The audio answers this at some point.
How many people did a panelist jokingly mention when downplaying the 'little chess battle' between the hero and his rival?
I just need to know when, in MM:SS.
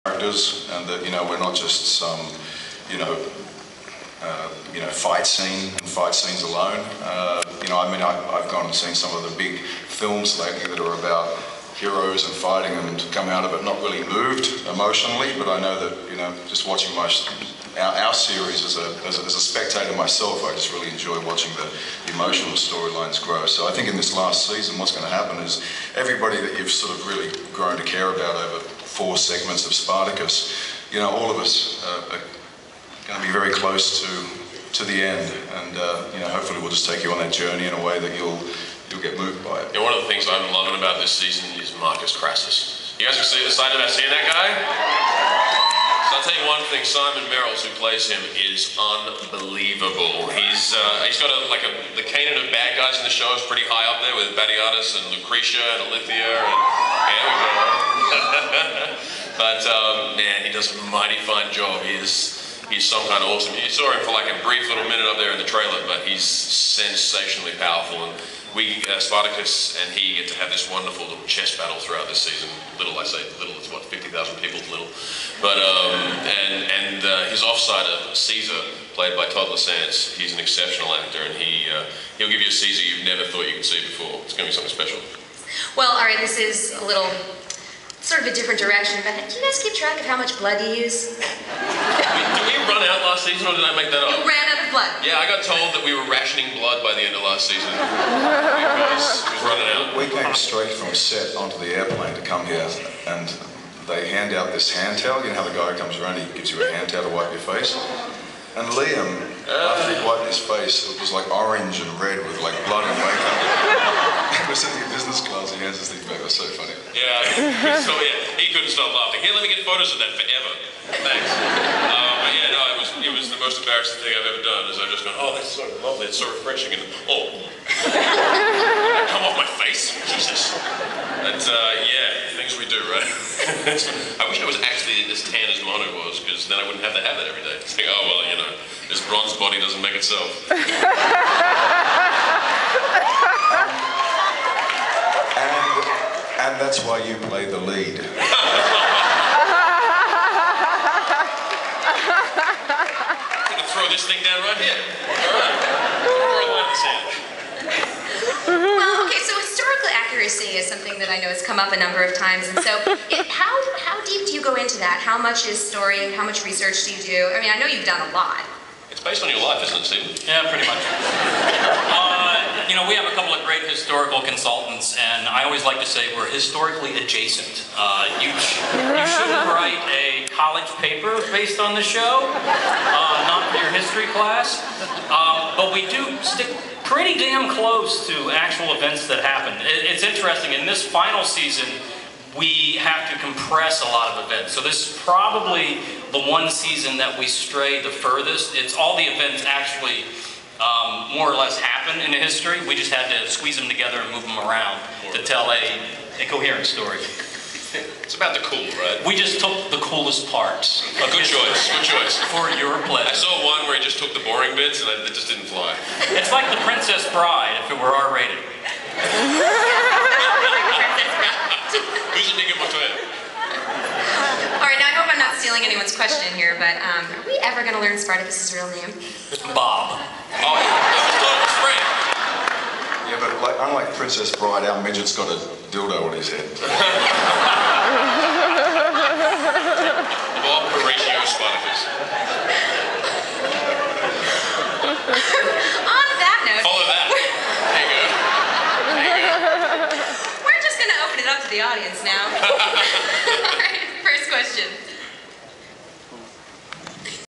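01:13.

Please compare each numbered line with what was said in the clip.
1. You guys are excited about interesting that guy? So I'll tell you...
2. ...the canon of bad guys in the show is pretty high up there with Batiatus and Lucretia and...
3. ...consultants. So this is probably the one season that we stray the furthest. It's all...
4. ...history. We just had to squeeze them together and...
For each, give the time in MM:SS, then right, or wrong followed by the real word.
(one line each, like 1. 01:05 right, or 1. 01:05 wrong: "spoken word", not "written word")
1. 00:42 wrong: "seeing", not "interesting"
2. 00:51 right
3. 03:14 wrong: "events", not "consultants"
4. 03:22 right.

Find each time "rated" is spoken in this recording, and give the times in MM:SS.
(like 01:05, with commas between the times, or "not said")
03:38.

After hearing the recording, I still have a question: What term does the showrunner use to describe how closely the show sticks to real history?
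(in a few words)
historically adjacent.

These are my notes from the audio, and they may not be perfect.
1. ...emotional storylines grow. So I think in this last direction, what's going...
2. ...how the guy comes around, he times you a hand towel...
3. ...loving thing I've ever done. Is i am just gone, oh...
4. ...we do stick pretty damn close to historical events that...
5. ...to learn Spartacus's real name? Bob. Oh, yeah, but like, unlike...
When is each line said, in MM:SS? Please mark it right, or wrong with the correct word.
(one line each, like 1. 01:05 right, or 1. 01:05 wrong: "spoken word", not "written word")
1. 00:22 wrong: "season", not "direction"
2. 01:45 wrong: "gives", not "times"
3. 02:03 wrong: "embarrassing", not "loving"
4. 03:05 wrong: "actual", not "historical"
5. 03:47 right.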